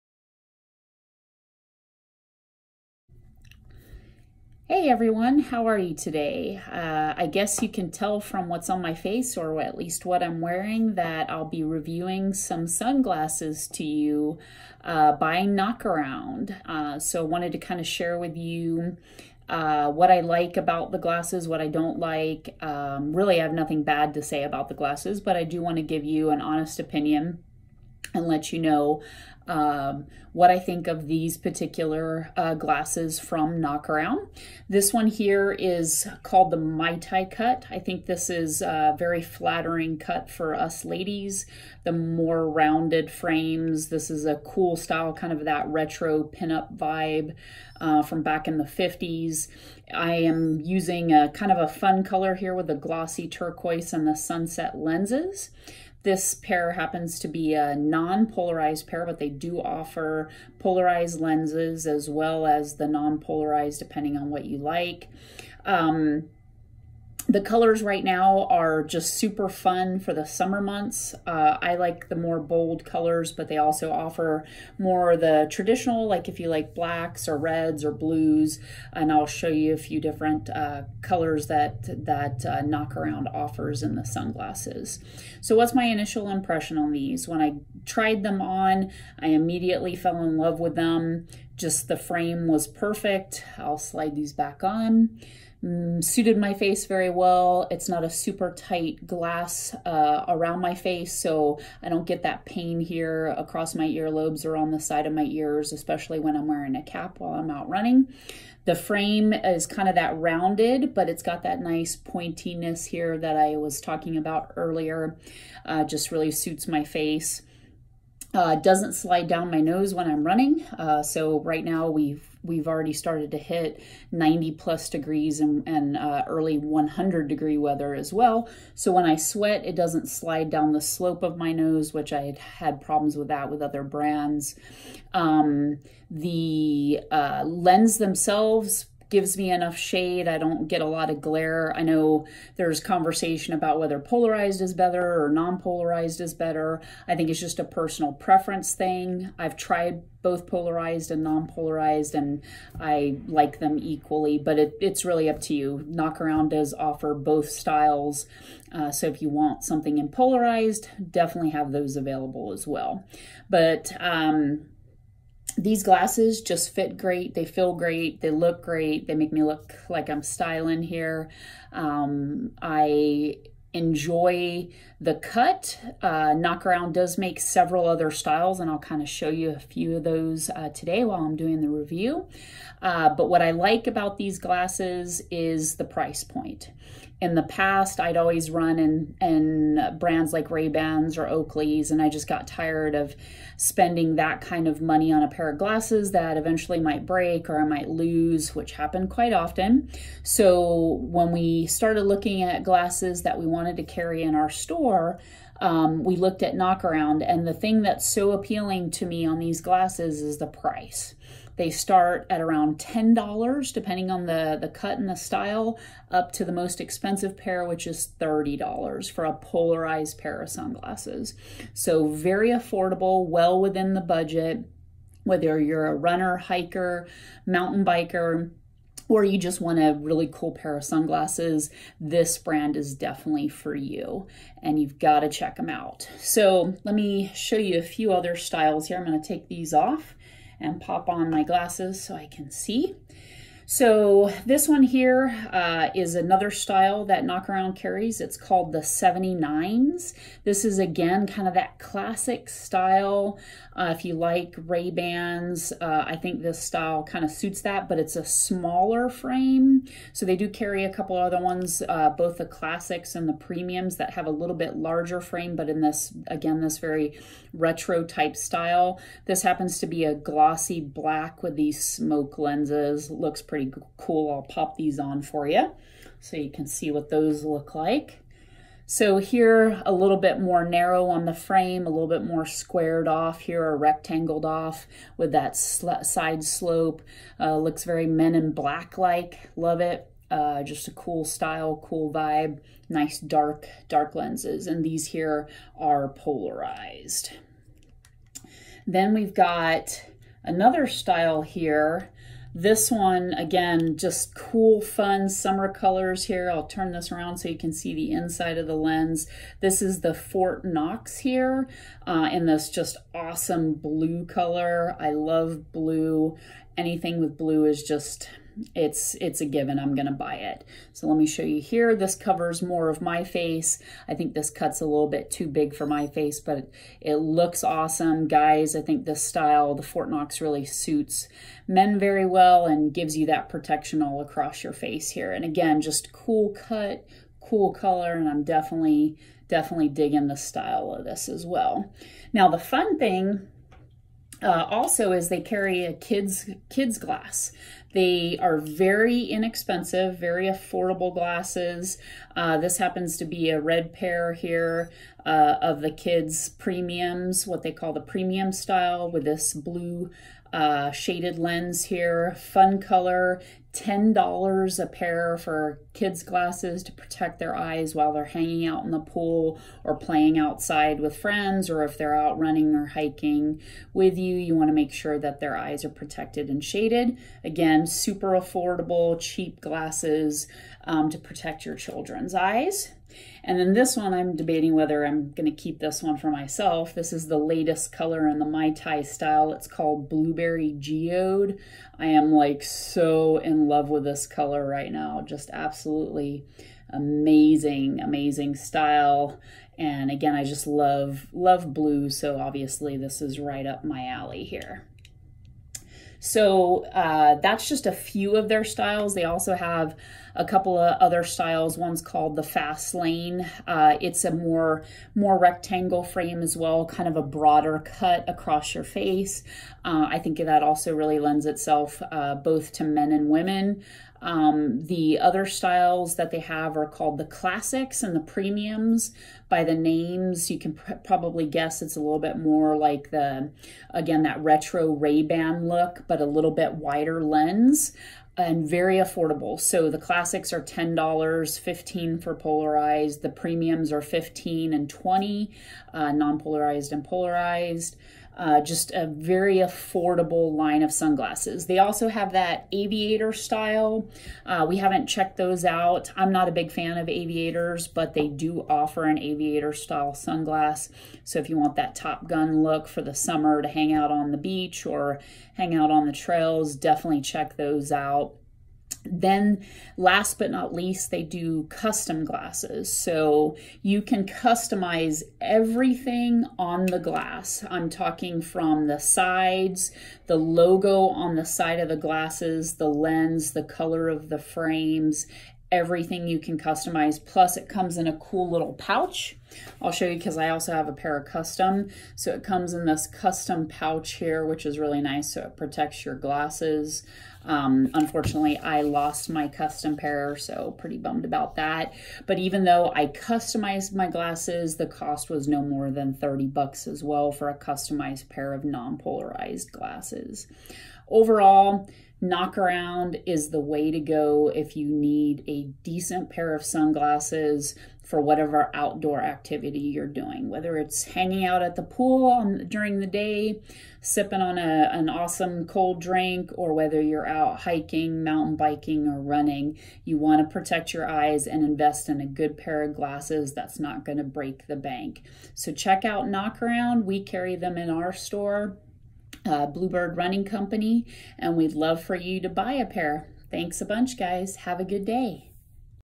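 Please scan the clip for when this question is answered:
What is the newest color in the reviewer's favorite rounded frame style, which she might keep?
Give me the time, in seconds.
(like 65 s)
390 s.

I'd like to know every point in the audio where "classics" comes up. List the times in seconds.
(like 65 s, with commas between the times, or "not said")
251 s, 262 s, 427 s, 439 s.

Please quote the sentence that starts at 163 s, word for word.
But um, these glasses just fit great.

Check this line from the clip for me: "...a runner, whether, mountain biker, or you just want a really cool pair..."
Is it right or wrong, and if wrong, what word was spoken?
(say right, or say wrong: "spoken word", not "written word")
wrong: "hiker", not "whether".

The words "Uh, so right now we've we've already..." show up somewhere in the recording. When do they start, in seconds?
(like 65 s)
120 s.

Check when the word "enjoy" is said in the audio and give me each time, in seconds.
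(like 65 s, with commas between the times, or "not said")
173 s.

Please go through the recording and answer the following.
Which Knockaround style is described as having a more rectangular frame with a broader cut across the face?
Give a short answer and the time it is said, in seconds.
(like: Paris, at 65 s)
Fast Lane, at 412 s.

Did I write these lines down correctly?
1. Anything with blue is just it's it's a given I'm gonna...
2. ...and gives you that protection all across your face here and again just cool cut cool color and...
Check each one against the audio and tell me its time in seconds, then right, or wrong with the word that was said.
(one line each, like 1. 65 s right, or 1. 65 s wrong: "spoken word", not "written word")
1. 316 s right
2. 332 s right.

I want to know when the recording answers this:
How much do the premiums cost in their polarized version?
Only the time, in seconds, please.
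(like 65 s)
444 s.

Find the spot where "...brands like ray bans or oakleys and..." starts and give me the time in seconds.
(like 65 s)
189 s.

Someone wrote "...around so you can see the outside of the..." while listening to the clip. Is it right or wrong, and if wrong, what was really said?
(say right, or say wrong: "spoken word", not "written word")
wrong: "inside", not "outside".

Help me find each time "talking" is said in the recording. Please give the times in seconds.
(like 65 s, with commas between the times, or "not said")
113 s, 477 s.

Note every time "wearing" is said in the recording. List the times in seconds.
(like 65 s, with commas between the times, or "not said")
10 s, 106 s.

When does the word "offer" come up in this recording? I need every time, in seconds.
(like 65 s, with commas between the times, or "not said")
59 s, 73 s, 83 s, 156 s, 458 s.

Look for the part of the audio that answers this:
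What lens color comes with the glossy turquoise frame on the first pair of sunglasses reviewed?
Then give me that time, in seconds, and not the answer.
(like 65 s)
54 s.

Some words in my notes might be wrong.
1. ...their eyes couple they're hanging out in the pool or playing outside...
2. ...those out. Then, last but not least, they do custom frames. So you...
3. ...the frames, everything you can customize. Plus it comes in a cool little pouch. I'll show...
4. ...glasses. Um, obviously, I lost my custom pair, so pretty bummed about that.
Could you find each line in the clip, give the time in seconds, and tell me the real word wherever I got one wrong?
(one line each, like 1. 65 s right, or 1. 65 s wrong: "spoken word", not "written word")
1. 367 s wrong: "while", not "couple"
2. 467 s wrong: "glasses", not "frames"
3. 484 s right
4. 496 s wrong: "unfortunately", not "obviously".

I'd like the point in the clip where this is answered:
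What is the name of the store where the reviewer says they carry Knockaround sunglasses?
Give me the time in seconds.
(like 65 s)
539 s.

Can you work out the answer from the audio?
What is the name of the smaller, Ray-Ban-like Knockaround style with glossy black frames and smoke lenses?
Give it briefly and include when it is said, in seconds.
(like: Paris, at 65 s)
79s, at 248 s.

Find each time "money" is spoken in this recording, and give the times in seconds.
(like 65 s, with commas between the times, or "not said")
194 s.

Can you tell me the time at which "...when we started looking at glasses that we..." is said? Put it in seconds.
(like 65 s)
201 s.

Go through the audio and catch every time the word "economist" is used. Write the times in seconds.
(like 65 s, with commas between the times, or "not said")
not said.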